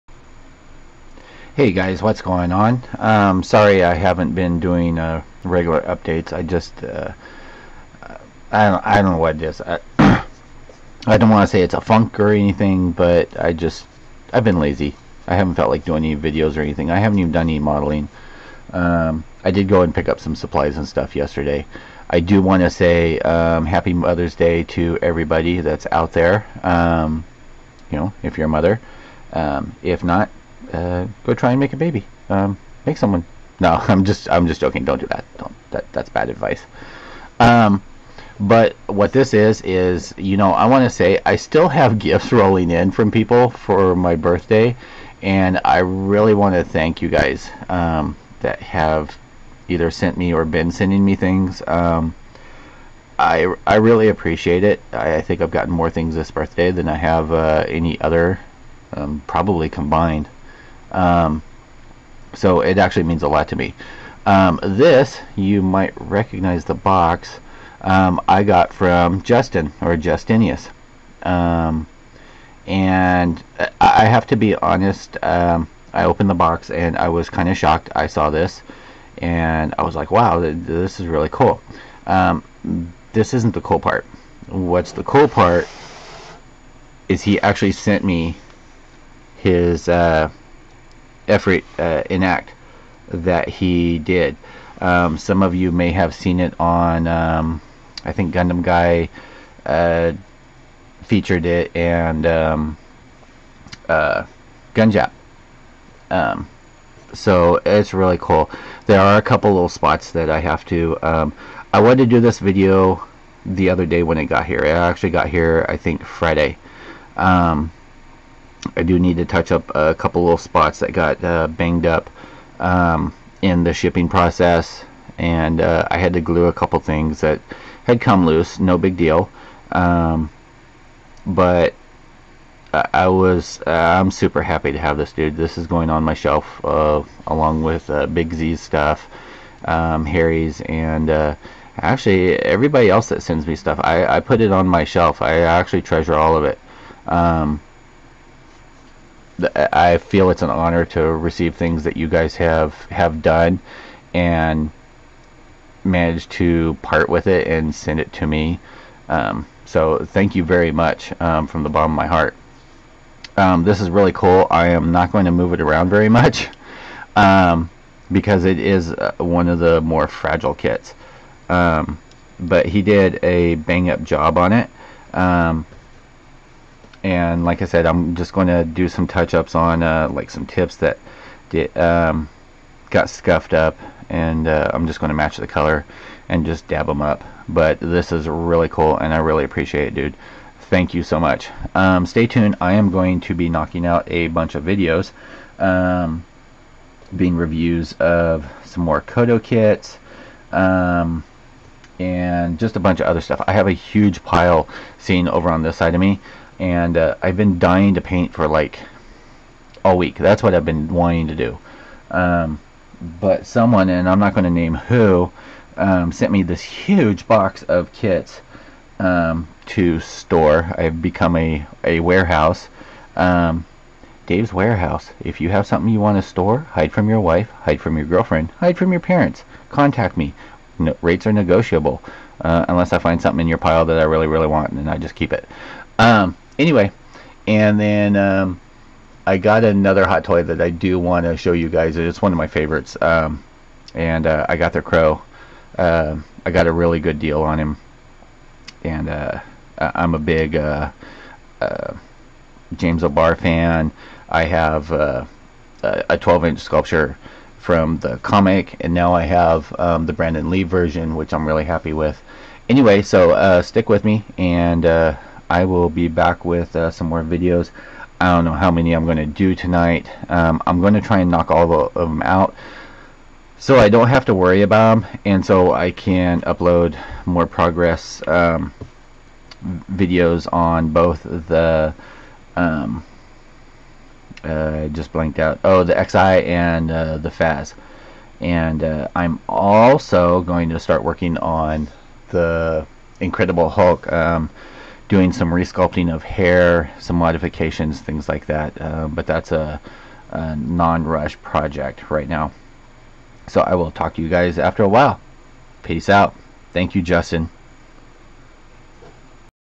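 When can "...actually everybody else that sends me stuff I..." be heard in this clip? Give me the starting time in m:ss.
2:21.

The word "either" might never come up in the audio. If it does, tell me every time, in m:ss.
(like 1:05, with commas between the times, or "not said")
0:49.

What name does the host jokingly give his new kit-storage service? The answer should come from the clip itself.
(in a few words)
Dave's Warehouse.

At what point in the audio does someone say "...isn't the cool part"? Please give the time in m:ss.
1:23.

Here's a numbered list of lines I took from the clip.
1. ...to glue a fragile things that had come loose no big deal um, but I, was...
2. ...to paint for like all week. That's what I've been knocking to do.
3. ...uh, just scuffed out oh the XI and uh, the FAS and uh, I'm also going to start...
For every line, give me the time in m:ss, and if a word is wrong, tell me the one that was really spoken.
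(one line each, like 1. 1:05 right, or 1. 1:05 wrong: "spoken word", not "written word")
1. 2:06 wrong: "couple", not "fragile"
2. 3:27 wrong: "wanting", not "knocking"
3. 4:44 wrong: "blanked", not "scuffed".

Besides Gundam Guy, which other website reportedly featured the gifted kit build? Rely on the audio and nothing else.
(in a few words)
Gunjap.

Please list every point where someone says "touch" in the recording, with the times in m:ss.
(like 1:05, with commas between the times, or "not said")
1:59, 2:59.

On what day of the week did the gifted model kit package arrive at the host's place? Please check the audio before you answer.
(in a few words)
Friday.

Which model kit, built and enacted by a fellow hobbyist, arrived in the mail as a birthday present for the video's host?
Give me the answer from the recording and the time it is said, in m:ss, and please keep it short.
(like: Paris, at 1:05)
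Efreet, at 1:31.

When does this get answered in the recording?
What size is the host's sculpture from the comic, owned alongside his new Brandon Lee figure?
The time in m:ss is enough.
4:16.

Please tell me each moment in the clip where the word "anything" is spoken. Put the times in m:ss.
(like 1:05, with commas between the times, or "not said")
0:12, 0:16.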